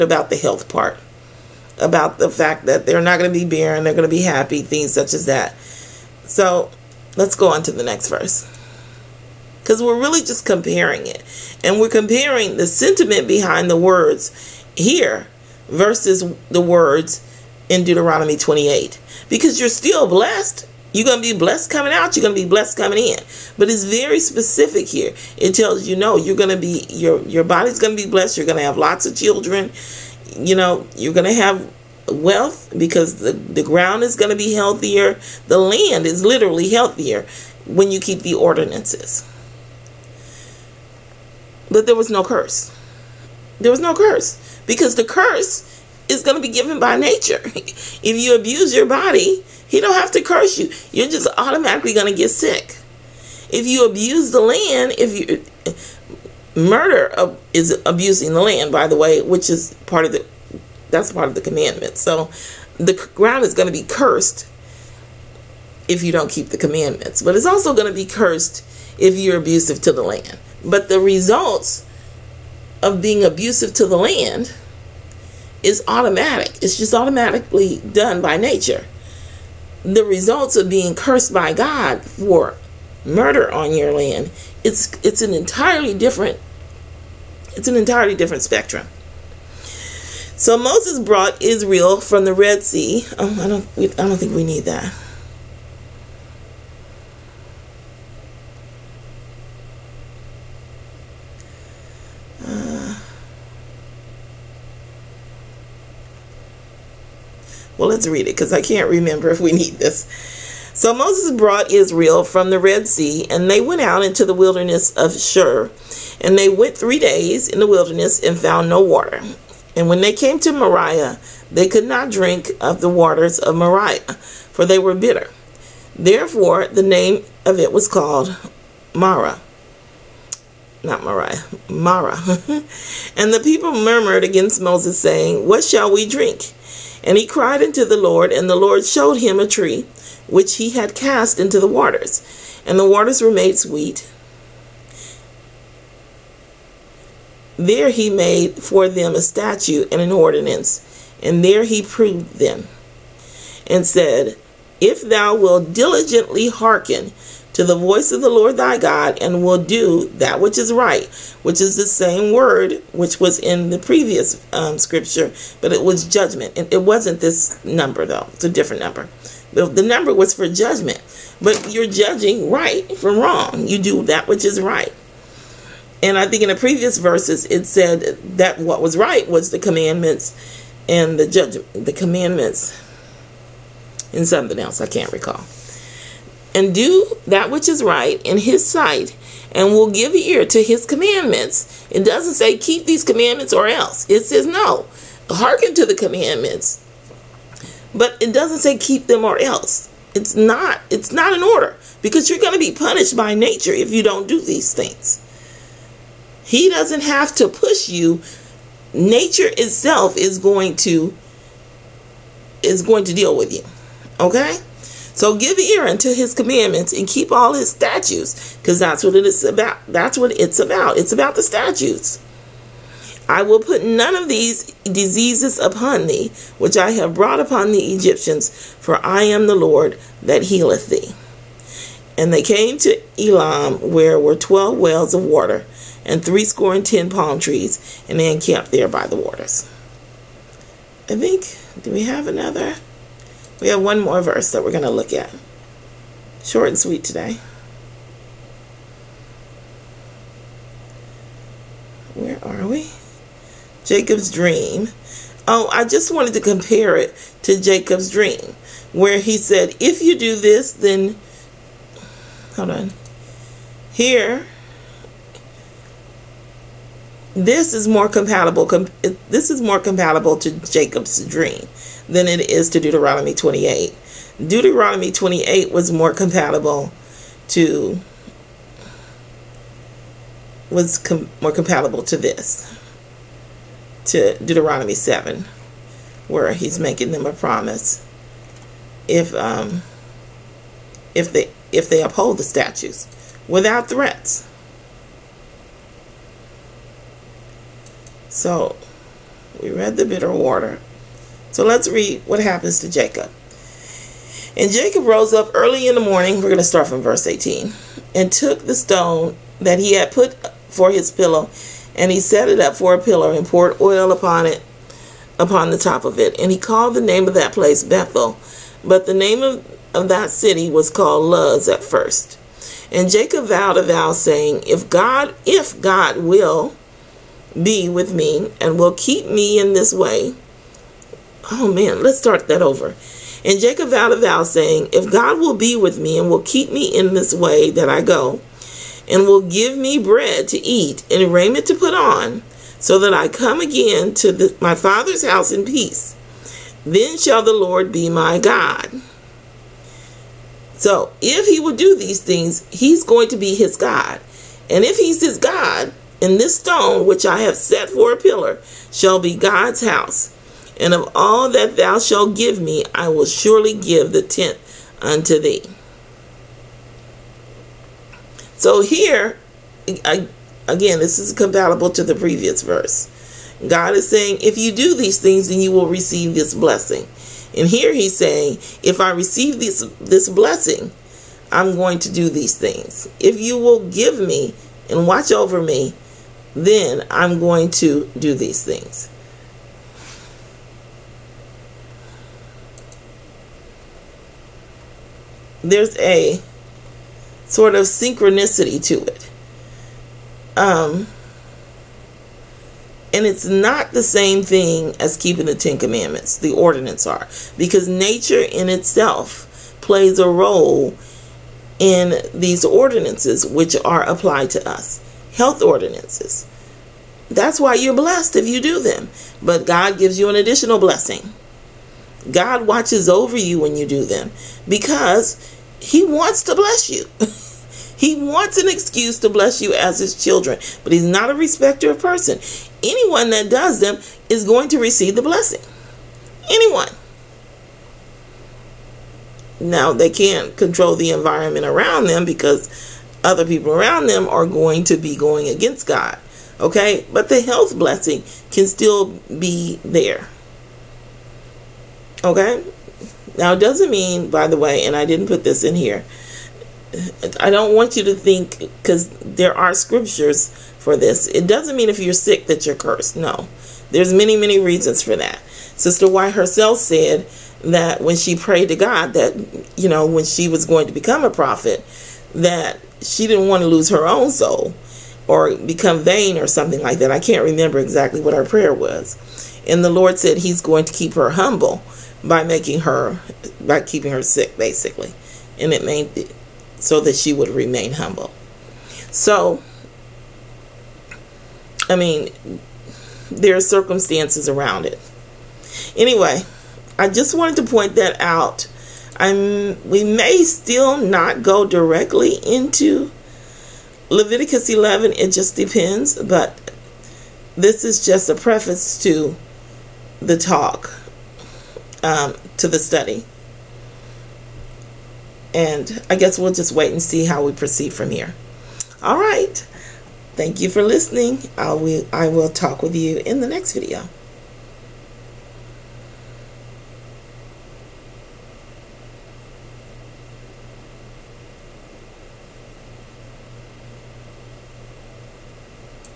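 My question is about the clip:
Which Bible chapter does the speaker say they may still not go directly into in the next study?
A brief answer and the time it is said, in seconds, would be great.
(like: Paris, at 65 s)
Leviticus 11, at 504 s.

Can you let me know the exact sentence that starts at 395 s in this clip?
There's a sort of synchronicity to it.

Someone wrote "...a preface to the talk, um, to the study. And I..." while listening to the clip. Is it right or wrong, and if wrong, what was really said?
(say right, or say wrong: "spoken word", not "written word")
right.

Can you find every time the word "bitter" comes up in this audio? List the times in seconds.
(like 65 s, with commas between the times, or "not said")
124 s, 300 s.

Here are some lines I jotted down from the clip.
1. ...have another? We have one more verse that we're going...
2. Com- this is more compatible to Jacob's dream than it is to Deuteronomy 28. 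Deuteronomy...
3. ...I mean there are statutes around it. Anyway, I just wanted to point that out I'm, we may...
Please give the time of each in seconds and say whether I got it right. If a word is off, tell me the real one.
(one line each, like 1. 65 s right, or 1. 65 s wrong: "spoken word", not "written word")
1. 242 s right
2. 268 s right
3. 491 s wrong: "circumstances", not "statutes".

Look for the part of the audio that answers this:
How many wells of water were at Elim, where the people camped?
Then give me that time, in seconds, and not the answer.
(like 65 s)
234 s.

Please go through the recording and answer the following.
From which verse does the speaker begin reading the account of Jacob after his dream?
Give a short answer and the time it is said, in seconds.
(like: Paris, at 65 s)
18, at 307 s.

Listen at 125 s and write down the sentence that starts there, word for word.
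Therefore, the name of it was called Marah, not Mariah, Marah.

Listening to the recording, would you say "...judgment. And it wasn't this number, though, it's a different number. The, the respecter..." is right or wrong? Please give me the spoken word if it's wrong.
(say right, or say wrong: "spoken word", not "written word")
wrong: "number", not "respecter".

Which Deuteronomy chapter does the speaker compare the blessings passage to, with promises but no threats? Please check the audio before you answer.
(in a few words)
Deuteronomy 7.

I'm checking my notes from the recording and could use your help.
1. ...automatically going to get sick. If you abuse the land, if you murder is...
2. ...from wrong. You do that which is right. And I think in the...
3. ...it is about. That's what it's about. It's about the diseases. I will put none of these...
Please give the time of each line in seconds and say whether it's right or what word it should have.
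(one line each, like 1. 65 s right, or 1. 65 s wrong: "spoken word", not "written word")
1. 51 s right
2. 172 s right
3. 219 s wrong: "statutes", not "diseases".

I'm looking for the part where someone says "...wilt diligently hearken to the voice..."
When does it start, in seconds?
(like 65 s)
155 s.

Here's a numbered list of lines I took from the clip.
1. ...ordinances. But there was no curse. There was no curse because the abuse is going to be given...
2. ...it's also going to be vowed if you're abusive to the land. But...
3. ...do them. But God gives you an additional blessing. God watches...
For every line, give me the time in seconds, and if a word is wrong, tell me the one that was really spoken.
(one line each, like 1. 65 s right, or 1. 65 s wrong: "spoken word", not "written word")
1. 38 s wrong: "curse", not "abuse"
2. 67 s wrong: "cursed", not "vowed"
3. 418 s right.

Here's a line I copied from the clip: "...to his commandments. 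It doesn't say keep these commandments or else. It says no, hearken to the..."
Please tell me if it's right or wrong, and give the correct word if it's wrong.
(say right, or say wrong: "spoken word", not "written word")
right.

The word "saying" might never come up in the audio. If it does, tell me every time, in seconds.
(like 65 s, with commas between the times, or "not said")
134 s, 324 s, 334 s, 374 s, 378 s.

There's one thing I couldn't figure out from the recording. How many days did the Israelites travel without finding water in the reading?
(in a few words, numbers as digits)
3.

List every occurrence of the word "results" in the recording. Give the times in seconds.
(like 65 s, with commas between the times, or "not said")
70 s, 80 s.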